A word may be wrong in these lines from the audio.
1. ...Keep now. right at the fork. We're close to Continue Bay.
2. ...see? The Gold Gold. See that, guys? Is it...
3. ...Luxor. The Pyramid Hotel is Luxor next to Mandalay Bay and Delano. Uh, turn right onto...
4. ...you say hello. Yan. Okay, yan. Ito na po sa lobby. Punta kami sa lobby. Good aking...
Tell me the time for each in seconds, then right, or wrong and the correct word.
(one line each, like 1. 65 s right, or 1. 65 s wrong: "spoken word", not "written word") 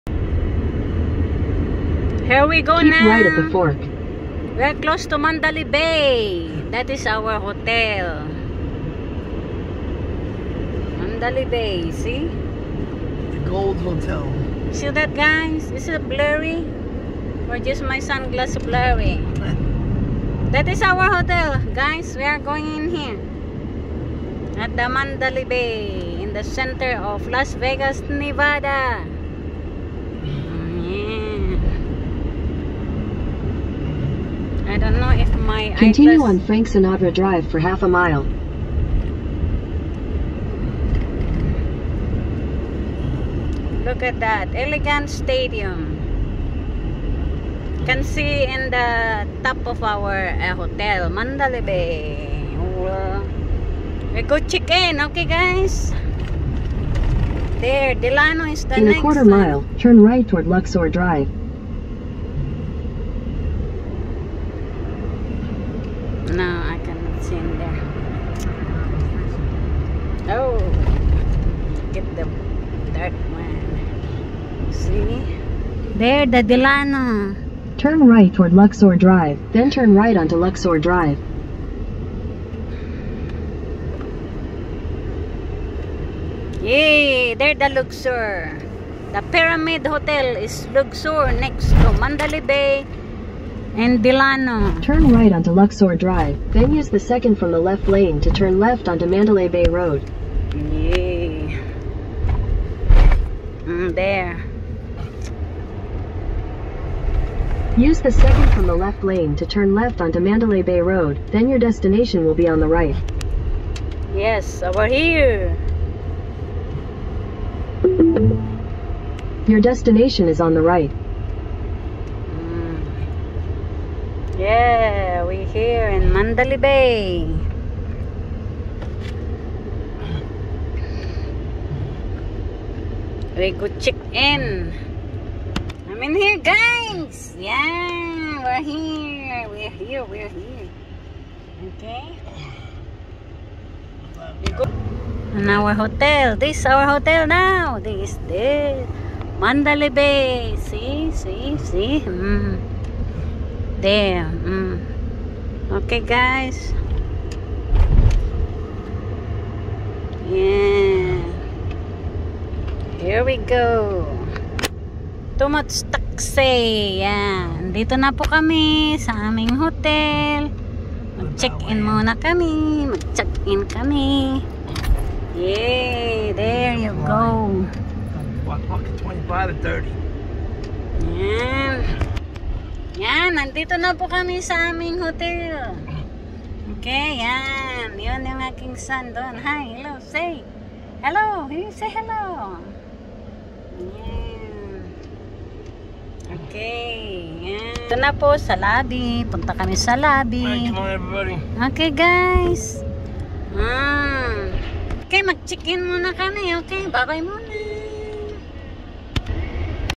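1. 2 s wrong: "Mandalay", not "Continue"
2. 11 s wrong: "Hotel", not "Gold"
3. 87 s right
4. 191 s wrong: "morning", not "aking".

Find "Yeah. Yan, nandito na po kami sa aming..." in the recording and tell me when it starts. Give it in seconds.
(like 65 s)
181 s.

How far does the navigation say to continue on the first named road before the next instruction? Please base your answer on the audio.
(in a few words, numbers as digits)
half a mile.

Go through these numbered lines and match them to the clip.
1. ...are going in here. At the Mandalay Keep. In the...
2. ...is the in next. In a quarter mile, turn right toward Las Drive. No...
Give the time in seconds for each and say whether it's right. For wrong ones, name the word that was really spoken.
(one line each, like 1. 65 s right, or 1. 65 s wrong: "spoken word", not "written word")
1. 22 s wrong: "Bay", not "Keep"
2. 58 s wrong: "Luxor", not "Las".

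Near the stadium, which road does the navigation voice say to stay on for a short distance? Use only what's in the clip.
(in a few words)
Frank Sinatra Drive.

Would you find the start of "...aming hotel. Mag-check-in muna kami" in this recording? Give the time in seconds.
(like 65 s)
169 s.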